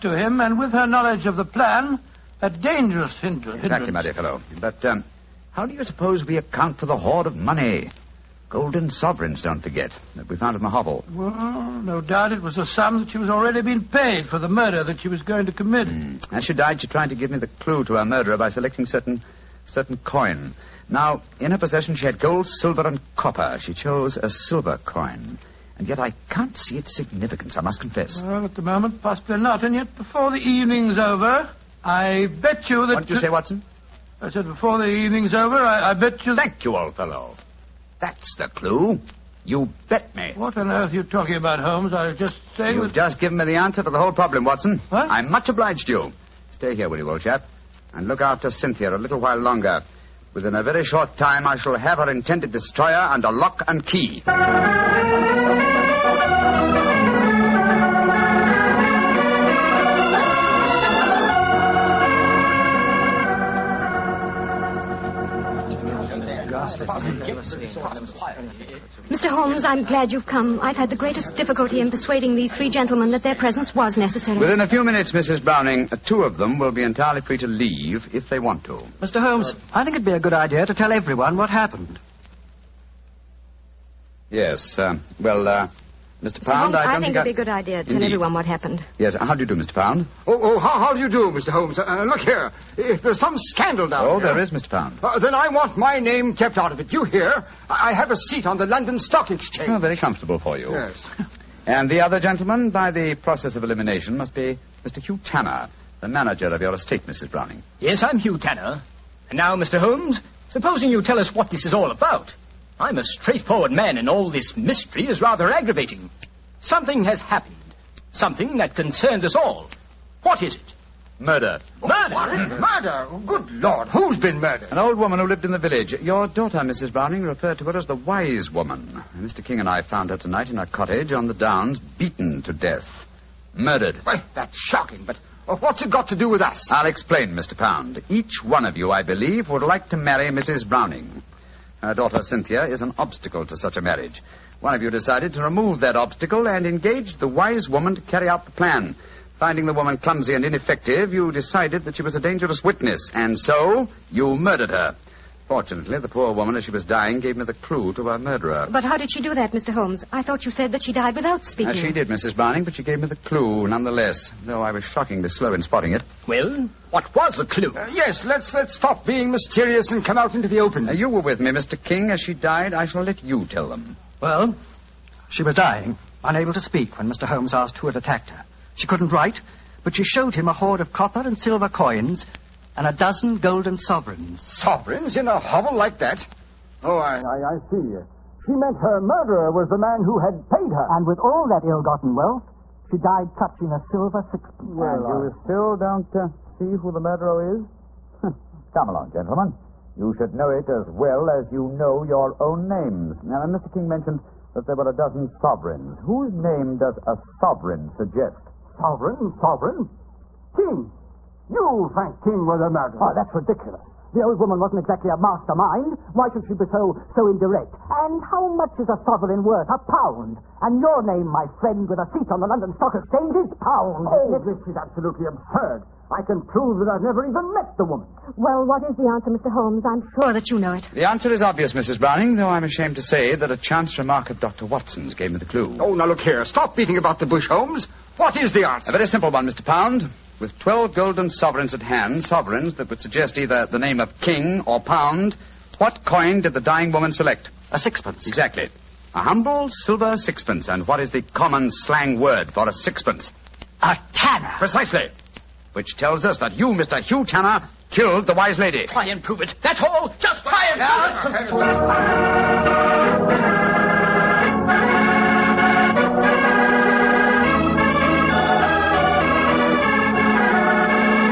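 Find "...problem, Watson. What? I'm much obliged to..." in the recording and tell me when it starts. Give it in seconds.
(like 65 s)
44 s.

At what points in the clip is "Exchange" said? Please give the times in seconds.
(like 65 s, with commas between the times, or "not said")
99 s, 222 s.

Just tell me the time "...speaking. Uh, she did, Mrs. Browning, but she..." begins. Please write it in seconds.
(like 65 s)
161 s.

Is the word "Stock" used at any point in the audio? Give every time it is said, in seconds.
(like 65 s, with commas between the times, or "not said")
98 s, 222 s.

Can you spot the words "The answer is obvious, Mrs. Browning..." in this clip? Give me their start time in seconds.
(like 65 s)
230 s.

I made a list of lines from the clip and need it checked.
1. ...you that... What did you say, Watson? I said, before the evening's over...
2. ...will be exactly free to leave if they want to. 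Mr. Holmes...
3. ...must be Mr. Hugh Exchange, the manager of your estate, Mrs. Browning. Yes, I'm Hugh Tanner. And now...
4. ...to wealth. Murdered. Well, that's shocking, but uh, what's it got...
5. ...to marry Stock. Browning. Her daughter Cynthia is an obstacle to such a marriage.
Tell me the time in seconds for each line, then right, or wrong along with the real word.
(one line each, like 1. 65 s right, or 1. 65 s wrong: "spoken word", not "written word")
1. 32 s right
2. 76 s wrong: "entirely", not "exactly"
3. 104 s wrong: "Tanner", not "Exchange"
4. 132 s wrong: "death", not "wealth"
5. 139 s wrong: "Mrs", not "Stock".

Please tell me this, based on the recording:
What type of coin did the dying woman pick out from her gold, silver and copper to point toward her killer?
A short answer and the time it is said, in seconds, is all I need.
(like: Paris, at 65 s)
silver coin, at 24 s.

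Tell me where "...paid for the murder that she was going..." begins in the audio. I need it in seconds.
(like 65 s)
13 s.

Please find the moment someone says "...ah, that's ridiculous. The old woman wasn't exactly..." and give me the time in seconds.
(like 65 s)
213 s.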